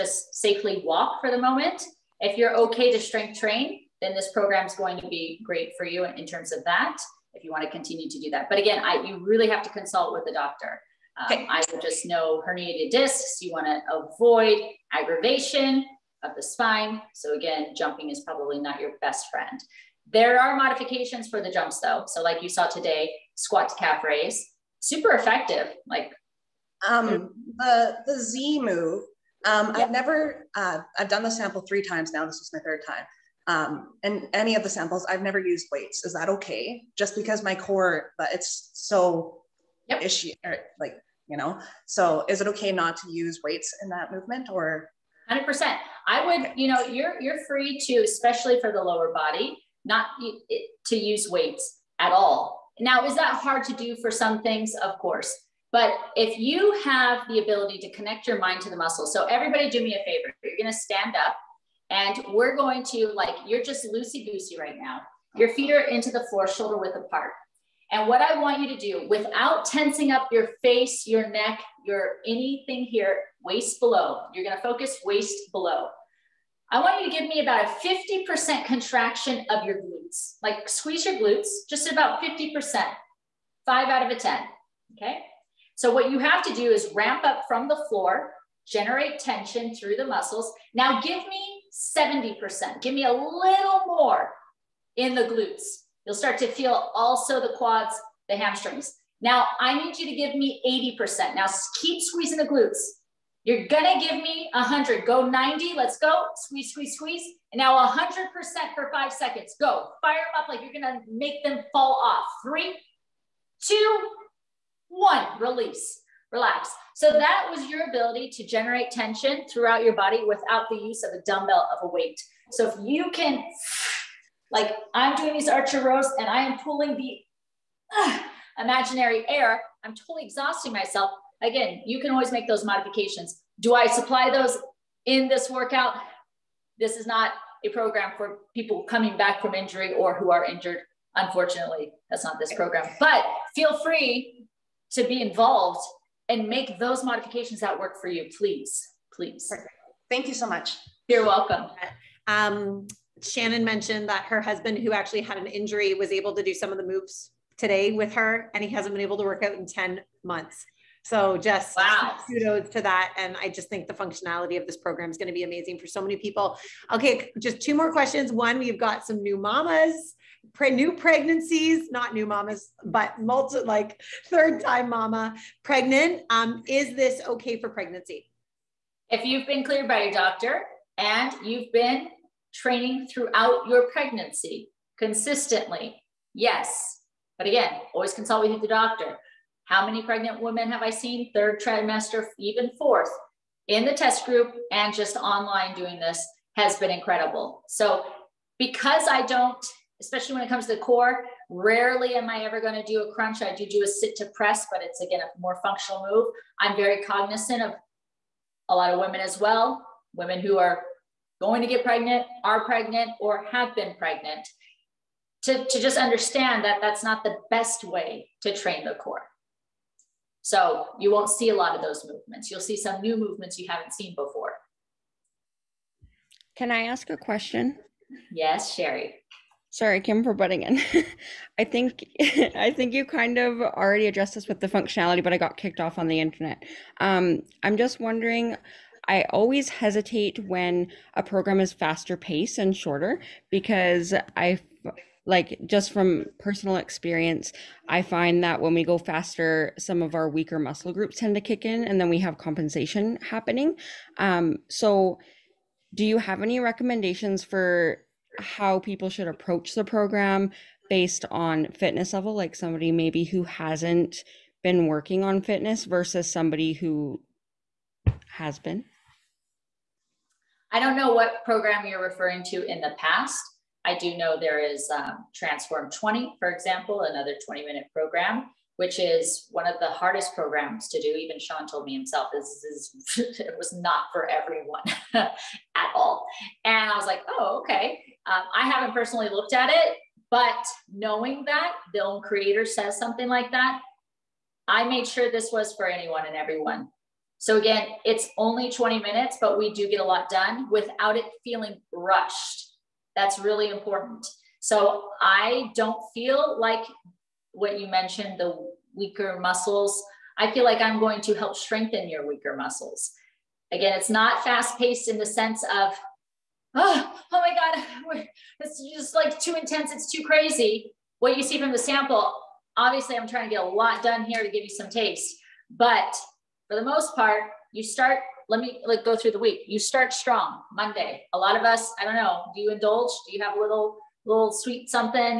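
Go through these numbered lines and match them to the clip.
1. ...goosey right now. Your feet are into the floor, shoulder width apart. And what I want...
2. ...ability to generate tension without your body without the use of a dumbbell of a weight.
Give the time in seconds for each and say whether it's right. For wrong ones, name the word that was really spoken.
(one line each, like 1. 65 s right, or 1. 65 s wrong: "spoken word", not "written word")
1. 64 s right
2. 117 s wrong: "throughout", not "without".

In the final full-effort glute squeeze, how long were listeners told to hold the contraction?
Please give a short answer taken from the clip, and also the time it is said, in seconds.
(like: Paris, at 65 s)
5 seconds, at 108 s.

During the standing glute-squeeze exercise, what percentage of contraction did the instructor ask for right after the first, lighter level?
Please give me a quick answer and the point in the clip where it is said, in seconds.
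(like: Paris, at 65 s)
70%, at 91 s.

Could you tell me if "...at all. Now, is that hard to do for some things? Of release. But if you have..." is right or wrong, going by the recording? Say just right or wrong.
wrong.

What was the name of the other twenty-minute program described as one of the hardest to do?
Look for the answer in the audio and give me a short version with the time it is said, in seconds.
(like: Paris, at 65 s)
Transform 20, at 275 s.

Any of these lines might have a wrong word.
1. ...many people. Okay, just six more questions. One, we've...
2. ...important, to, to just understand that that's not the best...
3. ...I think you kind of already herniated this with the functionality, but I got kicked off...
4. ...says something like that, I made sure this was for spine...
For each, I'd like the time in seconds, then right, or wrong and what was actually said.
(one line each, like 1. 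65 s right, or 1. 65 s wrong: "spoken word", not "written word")
1. 165 s wrong: "two", not "six"
2. 213 s wrong: "pregnant", not "important"
3. 232 s wrong: "addressed", not "herniated"
4. 292 s wrong: "anyone", not "spine".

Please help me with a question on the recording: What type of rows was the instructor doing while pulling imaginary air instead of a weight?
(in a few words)
archer rows.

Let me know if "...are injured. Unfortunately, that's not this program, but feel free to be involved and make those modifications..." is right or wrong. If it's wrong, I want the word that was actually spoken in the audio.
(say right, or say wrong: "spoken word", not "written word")
right.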